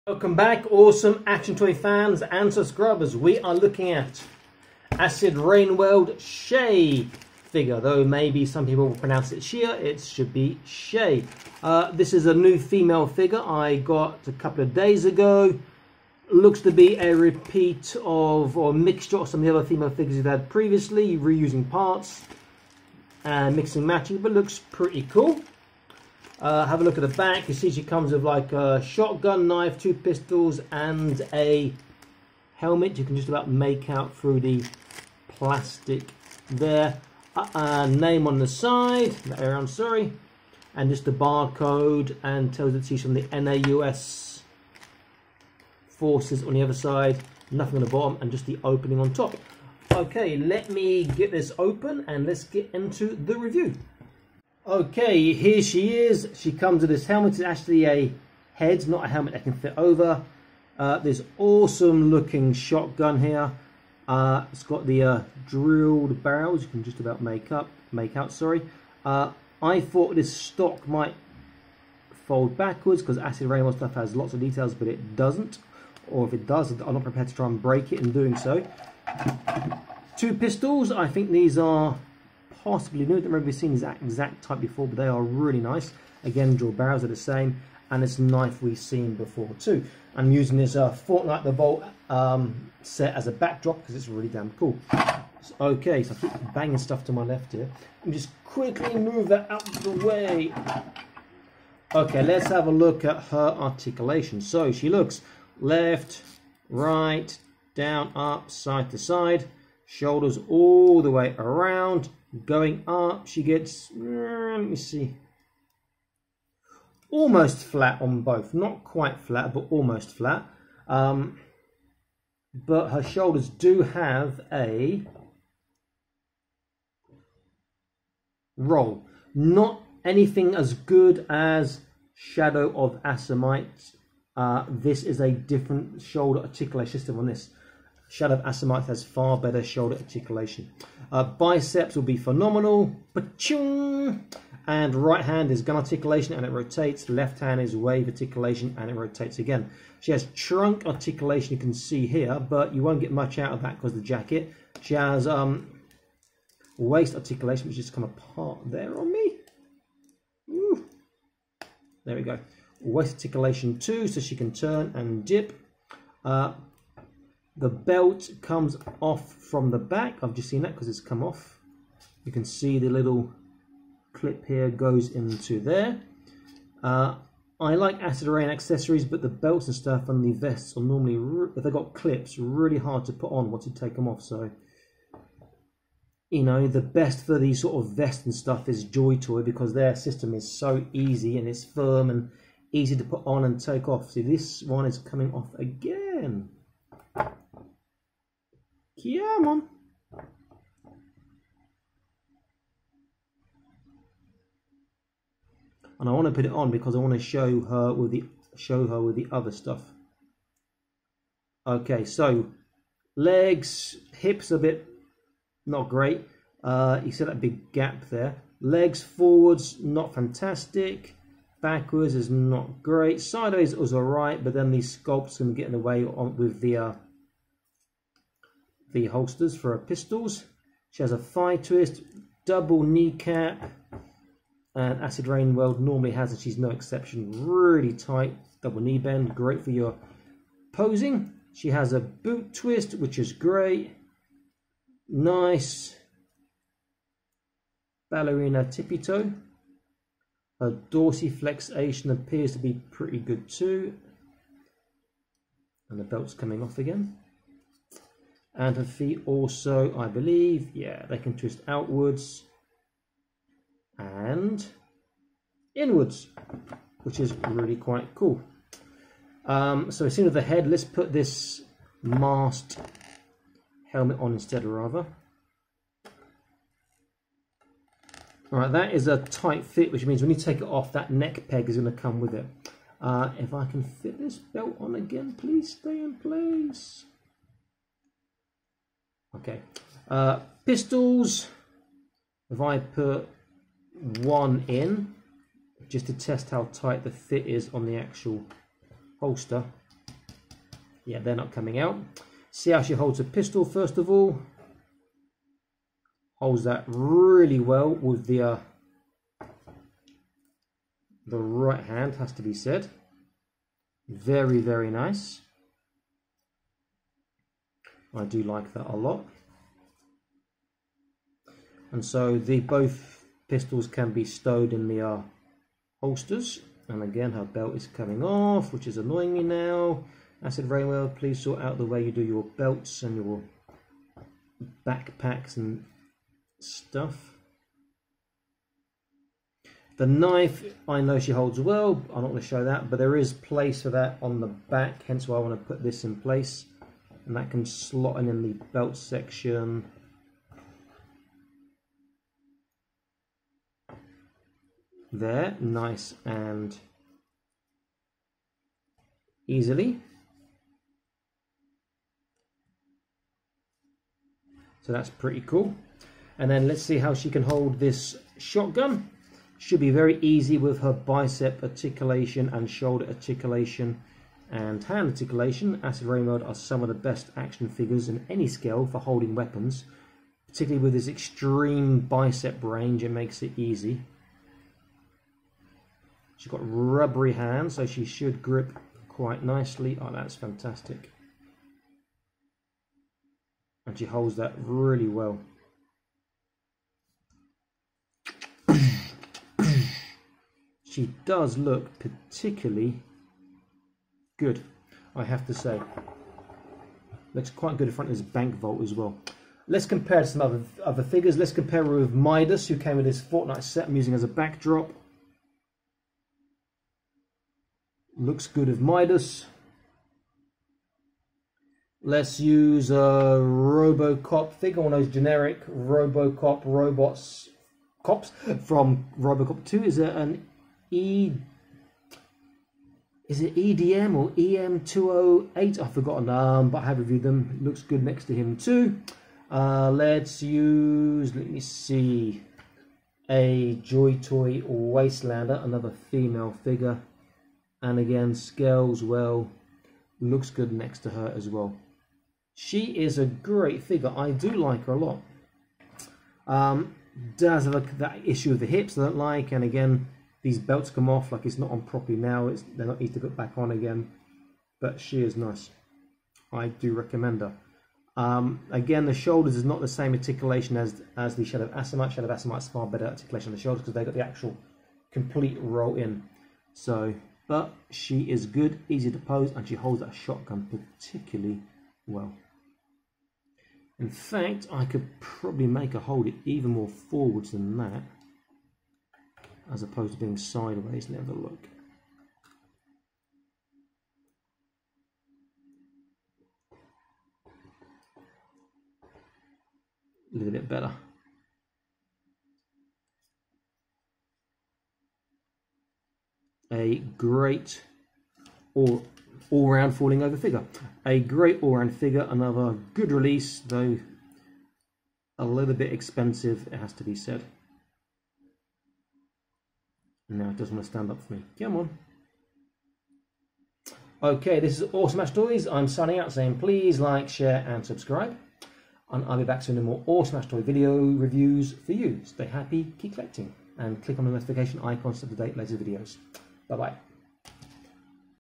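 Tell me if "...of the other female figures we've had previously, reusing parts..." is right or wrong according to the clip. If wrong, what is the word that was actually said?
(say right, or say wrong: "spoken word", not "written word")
right.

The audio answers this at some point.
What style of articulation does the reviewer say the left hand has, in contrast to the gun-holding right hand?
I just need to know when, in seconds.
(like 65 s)
147 s.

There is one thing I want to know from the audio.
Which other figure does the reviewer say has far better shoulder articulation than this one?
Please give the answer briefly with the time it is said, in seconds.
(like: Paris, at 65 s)
Shadow of Asamite, at 132 s.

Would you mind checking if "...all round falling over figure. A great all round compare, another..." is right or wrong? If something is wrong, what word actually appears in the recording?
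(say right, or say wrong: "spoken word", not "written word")
wrong: "figure", not "compare".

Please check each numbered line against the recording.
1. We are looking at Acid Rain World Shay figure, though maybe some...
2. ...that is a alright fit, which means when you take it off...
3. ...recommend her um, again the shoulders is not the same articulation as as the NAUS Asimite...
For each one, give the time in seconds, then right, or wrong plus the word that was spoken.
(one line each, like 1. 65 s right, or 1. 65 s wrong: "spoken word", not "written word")
1. 3 s right
2. 278 s wrong: "tight", not "alright"
3. 466 s wrong: "Shadow", not "NAUS".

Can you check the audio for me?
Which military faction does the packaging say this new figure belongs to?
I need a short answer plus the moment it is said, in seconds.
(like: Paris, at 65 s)
NAUS forces, at 43 s.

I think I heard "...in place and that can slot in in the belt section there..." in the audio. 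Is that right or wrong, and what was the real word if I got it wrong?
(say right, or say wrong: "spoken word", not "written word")
right.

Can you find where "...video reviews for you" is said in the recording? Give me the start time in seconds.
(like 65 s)
530 s.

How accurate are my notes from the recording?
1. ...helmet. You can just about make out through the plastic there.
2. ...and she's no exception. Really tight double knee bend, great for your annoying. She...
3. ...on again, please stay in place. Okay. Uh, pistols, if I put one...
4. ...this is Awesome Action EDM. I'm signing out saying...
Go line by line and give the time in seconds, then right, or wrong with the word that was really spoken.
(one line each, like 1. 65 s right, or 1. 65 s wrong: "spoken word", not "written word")
1. 32 s right
2. 236 s wrong: "posing", not "annoying"
3. 284 s right
4. 524 s wrong: "Toys", not "EDM".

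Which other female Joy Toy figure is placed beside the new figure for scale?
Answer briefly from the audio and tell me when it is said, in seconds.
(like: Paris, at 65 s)
Wastelander, at 444 s.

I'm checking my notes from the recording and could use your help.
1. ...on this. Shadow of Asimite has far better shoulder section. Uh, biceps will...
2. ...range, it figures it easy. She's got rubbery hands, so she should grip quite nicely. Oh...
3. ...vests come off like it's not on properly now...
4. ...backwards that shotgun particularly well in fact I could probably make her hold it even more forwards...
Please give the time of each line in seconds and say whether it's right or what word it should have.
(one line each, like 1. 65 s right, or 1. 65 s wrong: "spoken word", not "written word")
1. 137 s wrong: "articulation", not "section"
2. 382 s wrong: "makes", not "figures"
3. 460 s wrong: "belts", not "vests"
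4. 479 s wrong: "holds", not "backwards".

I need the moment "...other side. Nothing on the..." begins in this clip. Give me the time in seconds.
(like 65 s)
46 s.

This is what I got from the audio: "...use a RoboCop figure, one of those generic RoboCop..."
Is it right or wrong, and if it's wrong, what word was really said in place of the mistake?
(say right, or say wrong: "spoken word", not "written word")
right.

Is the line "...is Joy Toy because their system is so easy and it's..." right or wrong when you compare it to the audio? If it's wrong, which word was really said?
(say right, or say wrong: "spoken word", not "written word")
right.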